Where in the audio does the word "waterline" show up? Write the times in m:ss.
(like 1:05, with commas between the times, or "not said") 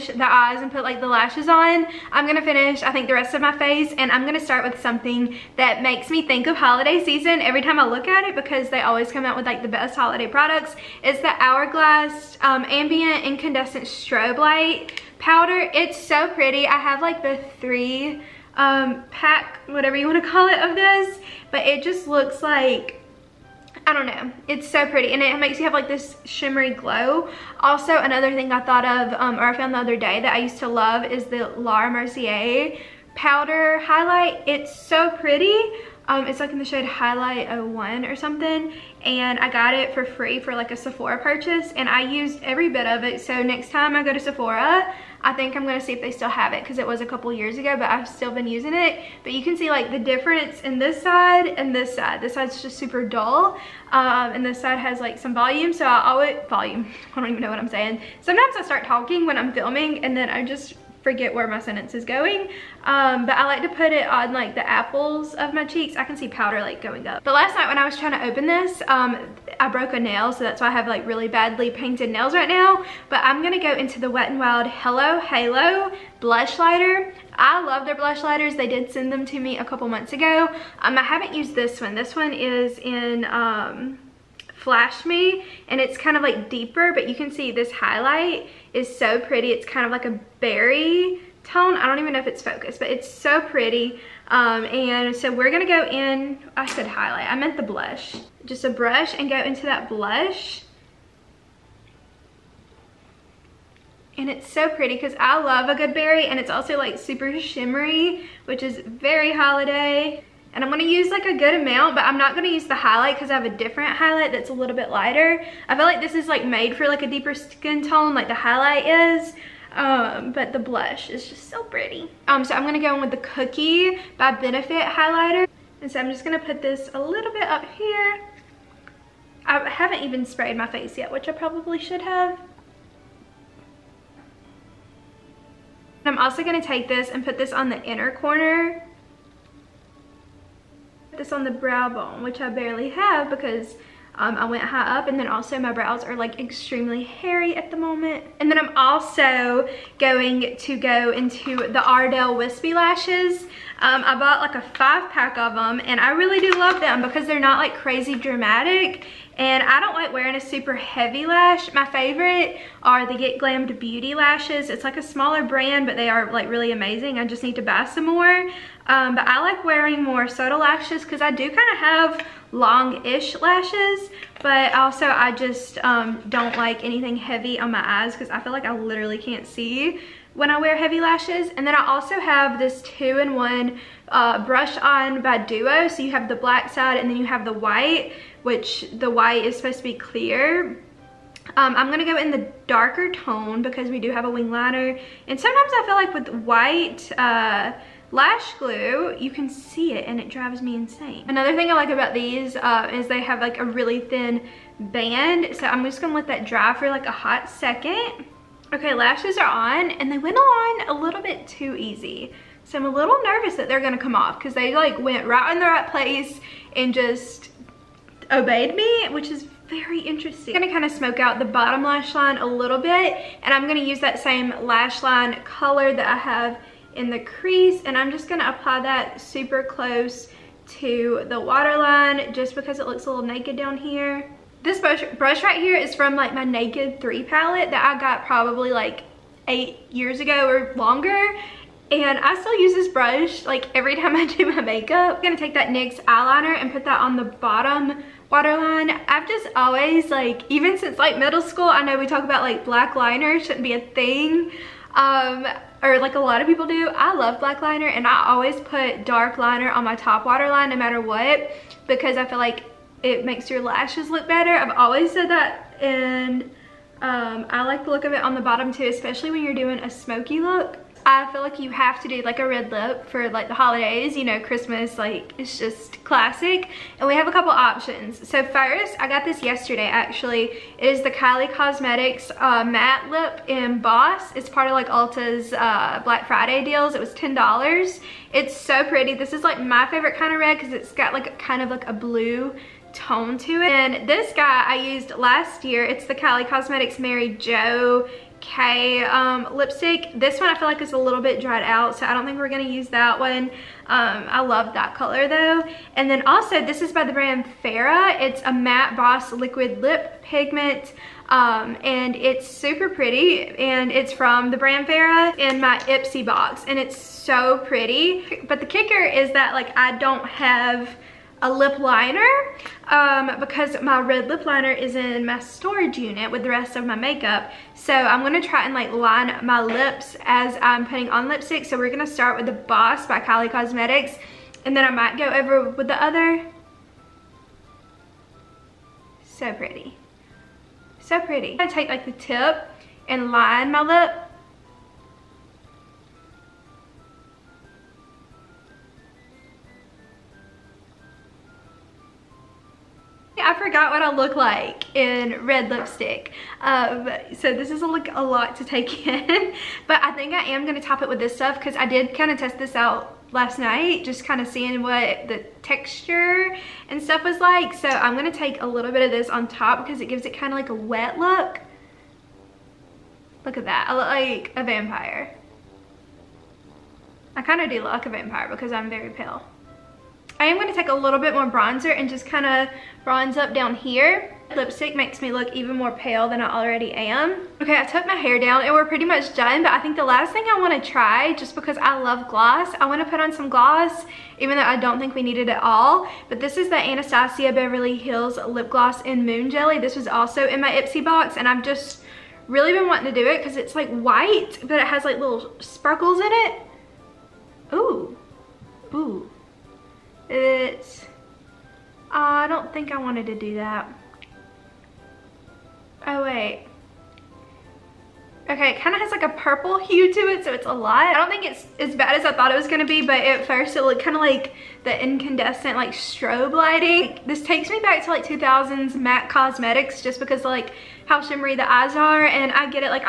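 3:51, 4:08, 4:20.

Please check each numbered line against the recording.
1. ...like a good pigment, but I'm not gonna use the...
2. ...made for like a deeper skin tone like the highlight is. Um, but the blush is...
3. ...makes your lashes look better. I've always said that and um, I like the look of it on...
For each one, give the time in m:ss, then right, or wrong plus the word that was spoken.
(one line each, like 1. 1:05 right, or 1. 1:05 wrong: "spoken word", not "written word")
1. 1:51 wrong: "amount", not "pigment"
2. 1:56 right
3. 4:23 right.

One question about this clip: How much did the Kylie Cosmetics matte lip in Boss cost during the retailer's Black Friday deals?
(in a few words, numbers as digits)
$10.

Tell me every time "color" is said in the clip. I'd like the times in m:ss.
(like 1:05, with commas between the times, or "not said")
3:45, 5:04.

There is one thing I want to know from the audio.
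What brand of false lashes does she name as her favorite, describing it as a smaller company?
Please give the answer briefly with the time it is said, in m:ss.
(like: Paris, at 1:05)
Get Glammed Beauty, at 2:43.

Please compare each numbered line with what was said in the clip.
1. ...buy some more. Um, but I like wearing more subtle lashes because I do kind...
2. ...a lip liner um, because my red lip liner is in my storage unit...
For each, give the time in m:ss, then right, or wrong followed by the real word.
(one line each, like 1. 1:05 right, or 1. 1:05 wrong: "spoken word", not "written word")
1. 2:47 right
2. 5:21 right.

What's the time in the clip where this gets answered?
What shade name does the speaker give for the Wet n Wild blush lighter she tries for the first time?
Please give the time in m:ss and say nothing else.
1:24.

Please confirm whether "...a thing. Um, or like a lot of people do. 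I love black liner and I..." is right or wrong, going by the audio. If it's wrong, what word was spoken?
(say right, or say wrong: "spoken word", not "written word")
right.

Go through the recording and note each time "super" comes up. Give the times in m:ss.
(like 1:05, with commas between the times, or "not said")
0:52, 1:46, 2:40, 3:49, 5:12.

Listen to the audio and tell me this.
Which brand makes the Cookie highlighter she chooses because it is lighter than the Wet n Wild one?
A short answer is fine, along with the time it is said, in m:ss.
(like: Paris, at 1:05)
Benefit, at 2:04.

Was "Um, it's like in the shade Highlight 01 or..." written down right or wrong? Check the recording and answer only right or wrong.
right.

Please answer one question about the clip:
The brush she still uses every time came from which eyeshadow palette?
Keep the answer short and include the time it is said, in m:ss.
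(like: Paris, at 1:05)
Naked 3, at 3:56.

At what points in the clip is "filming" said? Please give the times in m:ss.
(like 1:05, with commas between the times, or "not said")
0:59.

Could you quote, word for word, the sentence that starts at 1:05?
I can see powder like going up.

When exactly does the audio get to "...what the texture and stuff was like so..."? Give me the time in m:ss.
6:04.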